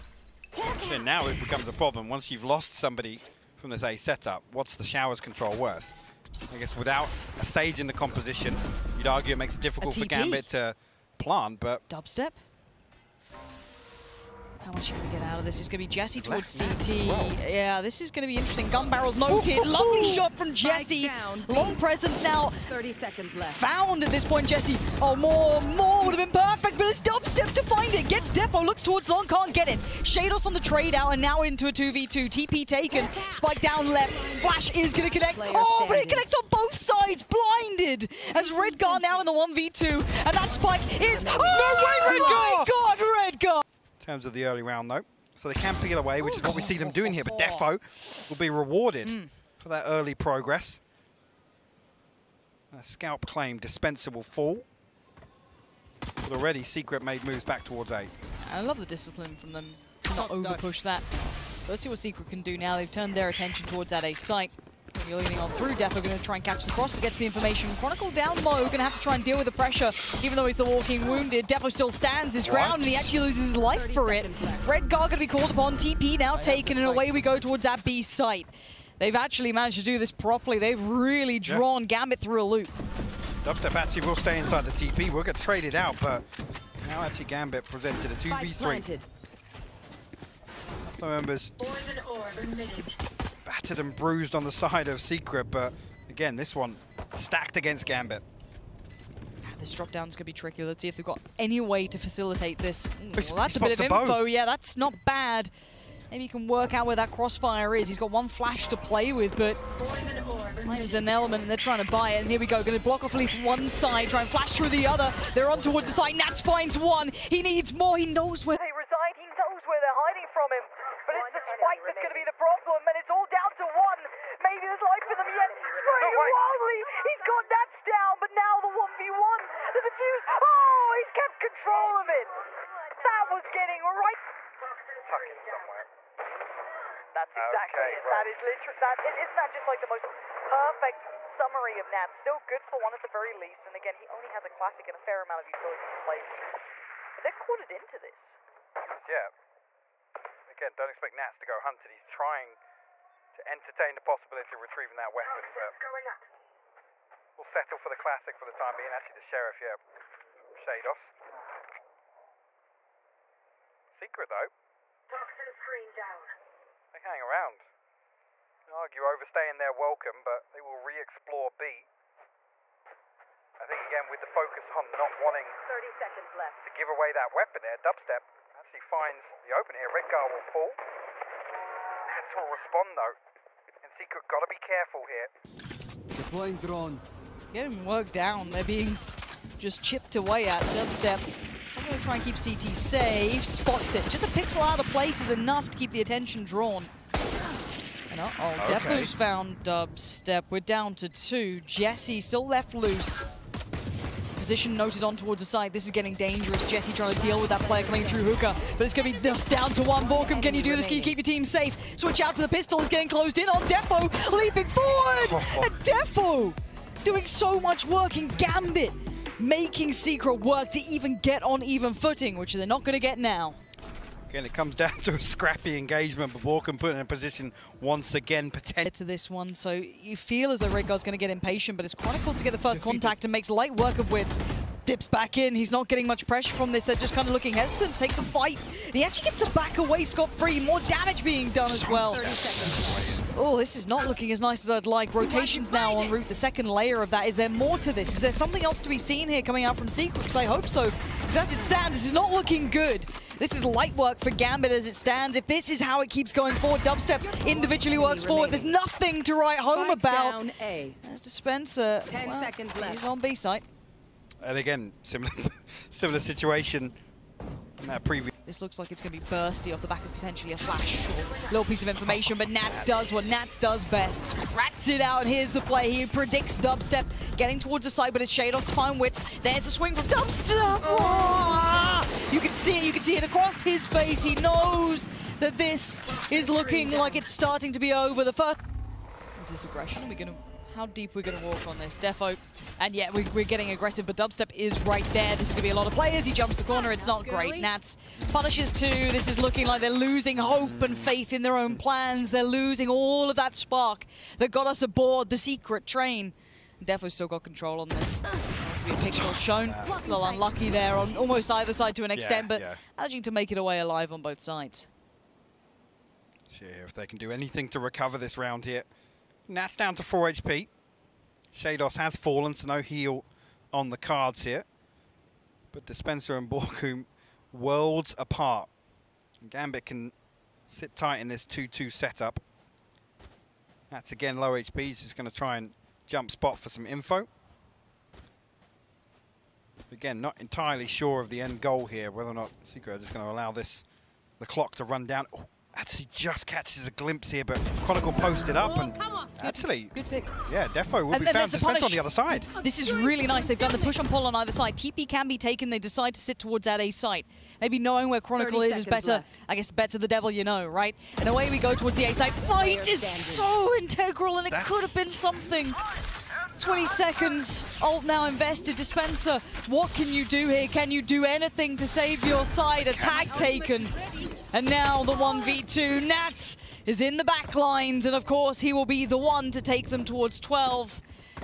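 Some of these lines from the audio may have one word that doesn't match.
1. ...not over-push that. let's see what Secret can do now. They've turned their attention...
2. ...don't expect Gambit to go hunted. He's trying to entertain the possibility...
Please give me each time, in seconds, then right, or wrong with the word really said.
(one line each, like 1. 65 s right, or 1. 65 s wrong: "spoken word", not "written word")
1. 60 s right
2. 150 s wrong: "Nats", not "Gambit".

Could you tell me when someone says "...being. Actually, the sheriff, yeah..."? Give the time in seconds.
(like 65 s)
158 s.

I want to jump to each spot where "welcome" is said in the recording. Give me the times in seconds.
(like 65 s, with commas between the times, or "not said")
169 s.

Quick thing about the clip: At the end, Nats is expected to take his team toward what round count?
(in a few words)
12.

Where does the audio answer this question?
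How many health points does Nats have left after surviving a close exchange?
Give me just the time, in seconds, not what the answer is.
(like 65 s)
320 s.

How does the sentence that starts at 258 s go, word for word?
There's nothing to write home about.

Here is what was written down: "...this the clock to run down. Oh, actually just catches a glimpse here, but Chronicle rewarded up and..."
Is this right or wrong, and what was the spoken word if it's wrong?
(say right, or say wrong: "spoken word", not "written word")
wrong: "posted", not "rewarded".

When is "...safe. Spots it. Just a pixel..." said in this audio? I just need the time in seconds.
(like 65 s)
192 s.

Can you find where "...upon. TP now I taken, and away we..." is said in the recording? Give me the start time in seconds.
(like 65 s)
75 s.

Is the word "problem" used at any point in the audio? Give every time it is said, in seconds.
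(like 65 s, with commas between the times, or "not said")
1 s, 122 s.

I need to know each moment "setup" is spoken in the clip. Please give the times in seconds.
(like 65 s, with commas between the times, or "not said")
3 s, 331 s.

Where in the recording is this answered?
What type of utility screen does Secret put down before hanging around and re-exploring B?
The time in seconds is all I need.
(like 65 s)
165 s.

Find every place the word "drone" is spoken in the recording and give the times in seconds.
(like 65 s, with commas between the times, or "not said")
186 s.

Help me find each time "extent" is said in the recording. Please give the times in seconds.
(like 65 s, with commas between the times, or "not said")
312 s.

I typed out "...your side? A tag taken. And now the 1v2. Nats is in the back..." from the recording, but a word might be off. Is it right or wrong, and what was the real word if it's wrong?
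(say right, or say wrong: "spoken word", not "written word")
right.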